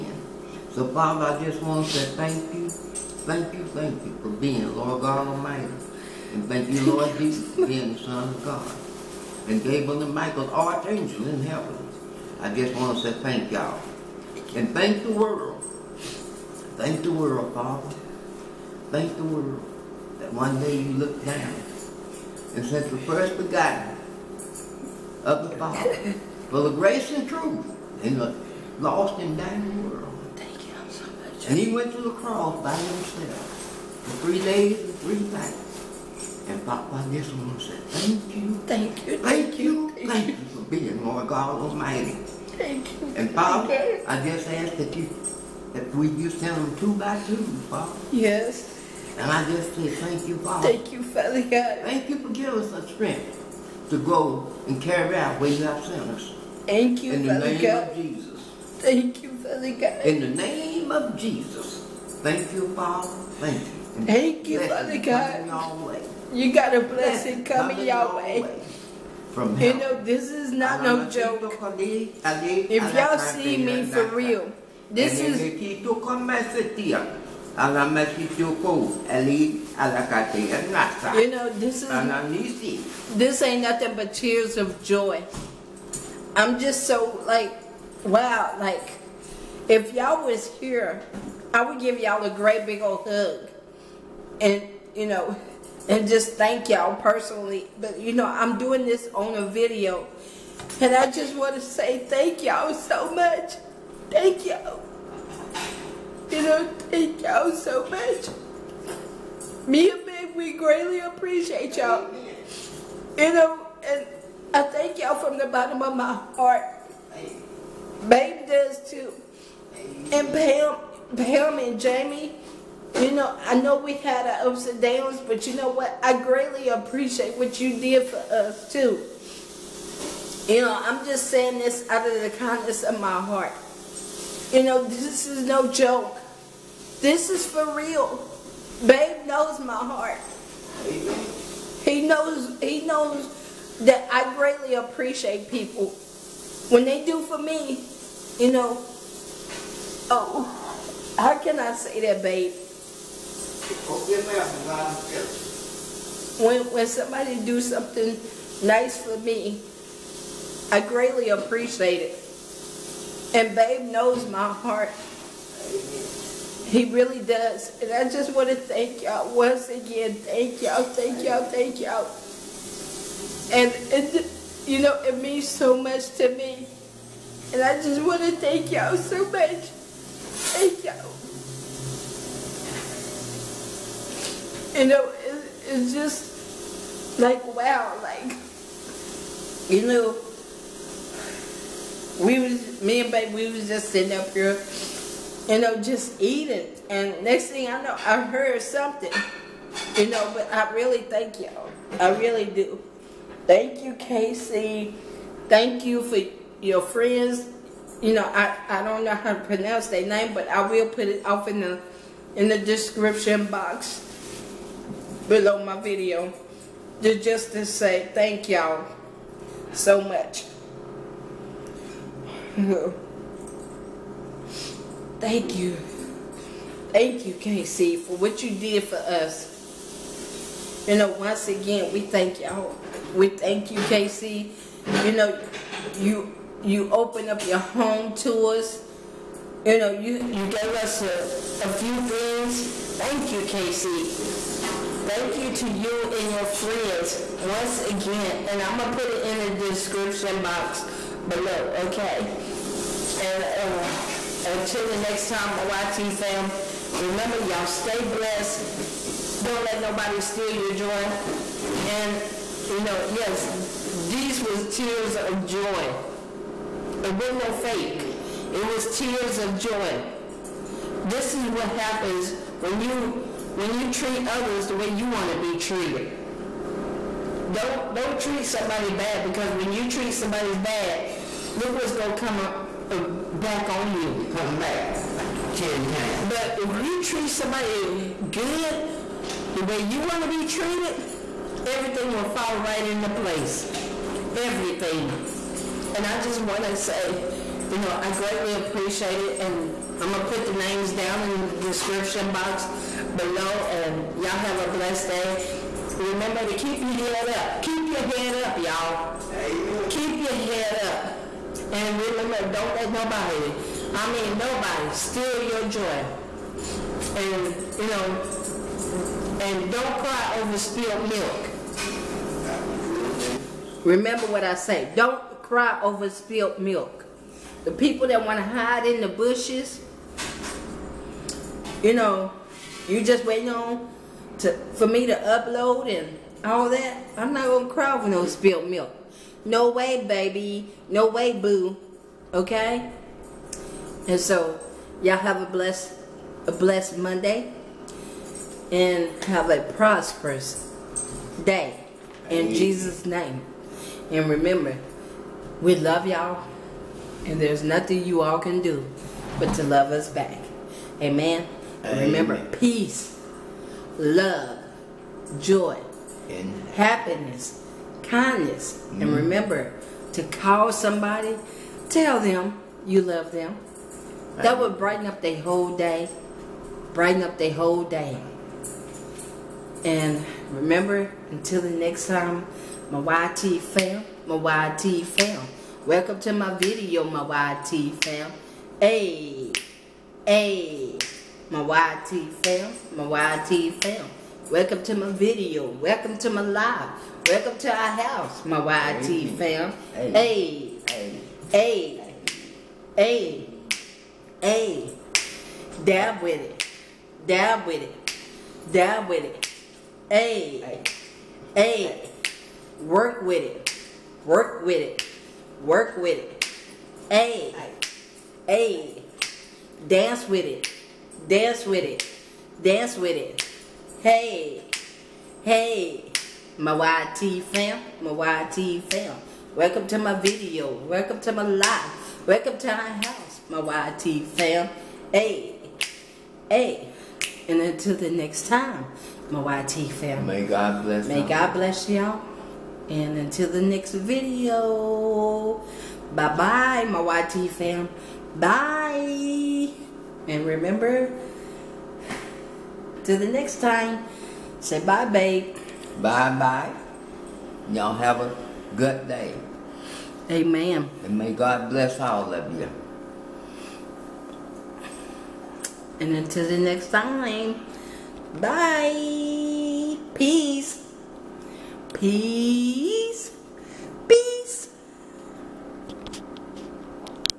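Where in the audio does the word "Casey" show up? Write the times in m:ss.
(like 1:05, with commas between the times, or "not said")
3:23, 3:47, 3:53, 4:03.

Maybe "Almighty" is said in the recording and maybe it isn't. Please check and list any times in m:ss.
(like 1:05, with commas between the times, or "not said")
0:05, 0:41.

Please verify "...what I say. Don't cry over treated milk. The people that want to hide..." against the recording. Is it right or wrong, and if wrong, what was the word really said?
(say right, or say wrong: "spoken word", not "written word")
wrong: "spilled", not "treated".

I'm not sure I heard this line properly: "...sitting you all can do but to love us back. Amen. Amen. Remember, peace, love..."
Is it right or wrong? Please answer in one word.
wrong.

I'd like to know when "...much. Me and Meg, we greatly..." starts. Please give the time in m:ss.
1:47.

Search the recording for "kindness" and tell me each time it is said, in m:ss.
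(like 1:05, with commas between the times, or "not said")
2:12, 6:08.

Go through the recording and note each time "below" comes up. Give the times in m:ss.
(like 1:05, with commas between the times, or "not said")
3:35, 4:11, 5:03.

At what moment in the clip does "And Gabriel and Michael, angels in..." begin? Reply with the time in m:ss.
0:09.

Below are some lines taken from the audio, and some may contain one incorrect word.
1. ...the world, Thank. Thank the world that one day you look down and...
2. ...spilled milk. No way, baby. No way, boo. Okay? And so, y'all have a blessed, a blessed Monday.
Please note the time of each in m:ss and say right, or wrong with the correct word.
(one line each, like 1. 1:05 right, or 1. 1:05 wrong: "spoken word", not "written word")
1. 0:17 wrong: "Father", not "Thank"
2. 5:38 right.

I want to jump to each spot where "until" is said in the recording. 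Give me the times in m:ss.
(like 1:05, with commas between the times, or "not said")
4:14, 6:21, 7:17, 7:23, 7:46.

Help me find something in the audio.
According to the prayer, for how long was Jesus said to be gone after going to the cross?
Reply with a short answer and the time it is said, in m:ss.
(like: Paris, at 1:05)
3 days and 3 nights, at 0:34.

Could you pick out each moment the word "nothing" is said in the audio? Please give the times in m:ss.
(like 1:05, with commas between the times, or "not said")
1:23, 5:57.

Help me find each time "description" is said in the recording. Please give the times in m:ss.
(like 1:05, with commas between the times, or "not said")
3:32, 4:09, 5:01.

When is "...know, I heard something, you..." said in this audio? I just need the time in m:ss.
3:17.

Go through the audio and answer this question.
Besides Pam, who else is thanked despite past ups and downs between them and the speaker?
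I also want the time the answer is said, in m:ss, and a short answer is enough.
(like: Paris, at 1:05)
Jamie, at 2:01.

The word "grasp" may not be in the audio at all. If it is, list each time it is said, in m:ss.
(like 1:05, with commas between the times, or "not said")
not said.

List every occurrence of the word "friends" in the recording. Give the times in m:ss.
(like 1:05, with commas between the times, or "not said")
3:26, 4:06.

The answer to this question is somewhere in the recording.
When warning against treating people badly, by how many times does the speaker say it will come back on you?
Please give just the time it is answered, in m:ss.
4:45.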